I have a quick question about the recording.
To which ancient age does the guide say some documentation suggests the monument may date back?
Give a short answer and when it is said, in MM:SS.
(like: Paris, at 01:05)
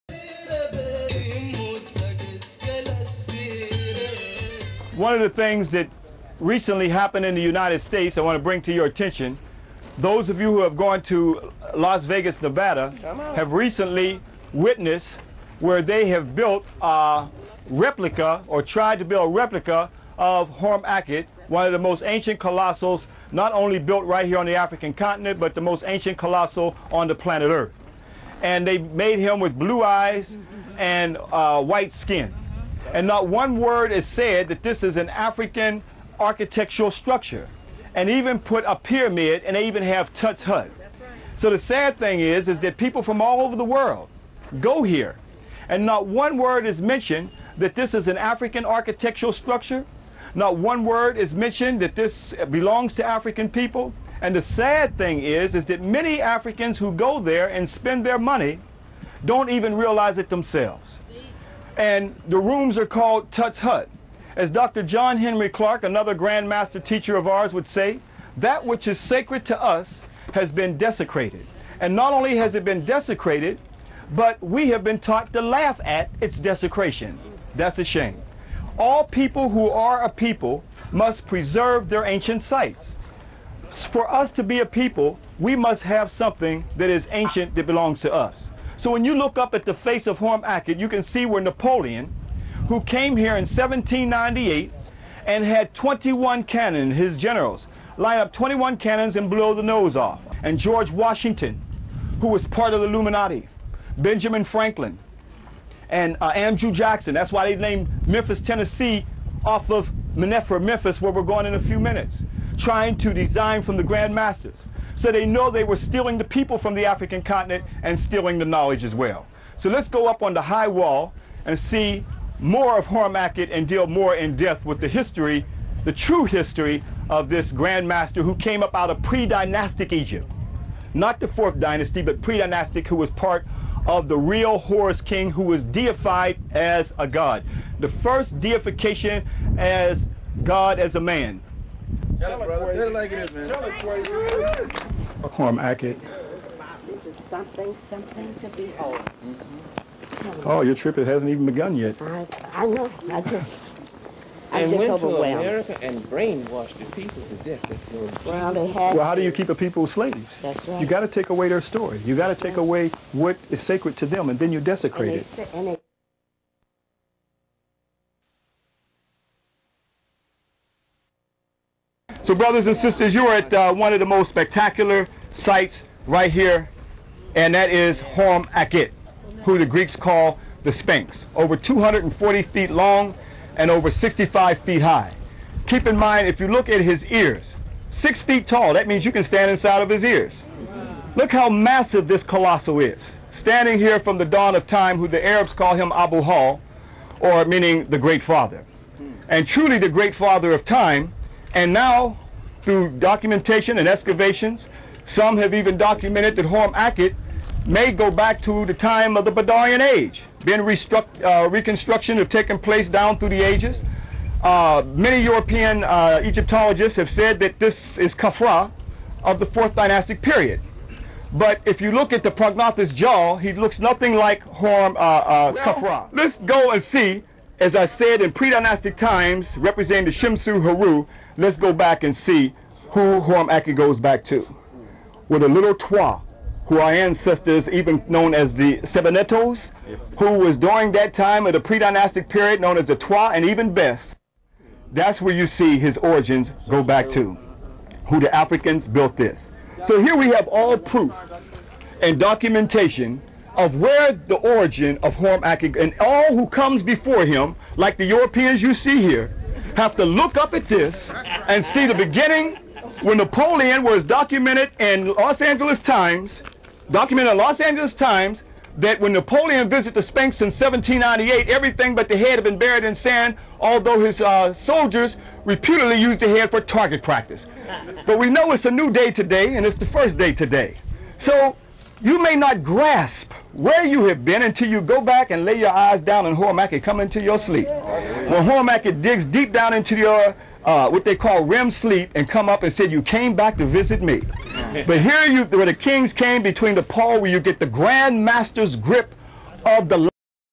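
Badarian Age, at 03:29.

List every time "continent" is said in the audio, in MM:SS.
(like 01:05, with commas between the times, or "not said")
00:24, 01:57.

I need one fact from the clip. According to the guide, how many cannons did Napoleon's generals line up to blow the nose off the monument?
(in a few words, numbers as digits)
21.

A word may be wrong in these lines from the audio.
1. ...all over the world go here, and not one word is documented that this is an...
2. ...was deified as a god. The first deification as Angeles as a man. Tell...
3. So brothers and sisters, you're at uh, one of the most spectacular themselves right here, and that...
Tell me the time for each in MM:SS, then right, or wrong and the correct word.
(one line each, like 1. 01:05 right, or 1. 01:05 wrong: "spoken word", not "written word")
1. 00:43 wrong: "mentioned", not "documented"
2. 02:15 wrong: "God", not "Angeles"
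3. 02:52 wrong: "sites", not "themselves".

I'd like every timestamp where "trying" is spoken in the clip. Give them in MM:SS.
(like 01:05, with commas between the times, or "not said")
01:52.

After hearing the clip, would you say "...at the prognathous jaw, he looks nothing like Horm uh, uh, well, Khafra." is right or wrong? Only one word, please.
right.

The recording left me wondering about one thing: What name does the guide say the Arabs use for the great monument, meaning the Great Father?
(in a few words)
Abu Hal.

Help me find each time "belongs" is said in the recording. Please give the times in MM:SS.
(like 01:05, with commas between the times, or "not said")
00:52, 01:27.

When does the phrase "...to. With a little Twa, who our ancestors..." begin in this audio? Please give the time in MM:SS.
03:54.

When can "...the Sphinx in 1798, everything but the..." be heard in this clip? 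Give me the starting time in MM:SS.
04:29.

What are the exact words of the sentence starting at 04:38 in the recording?
But we know it's a new day today, and it's the first day today.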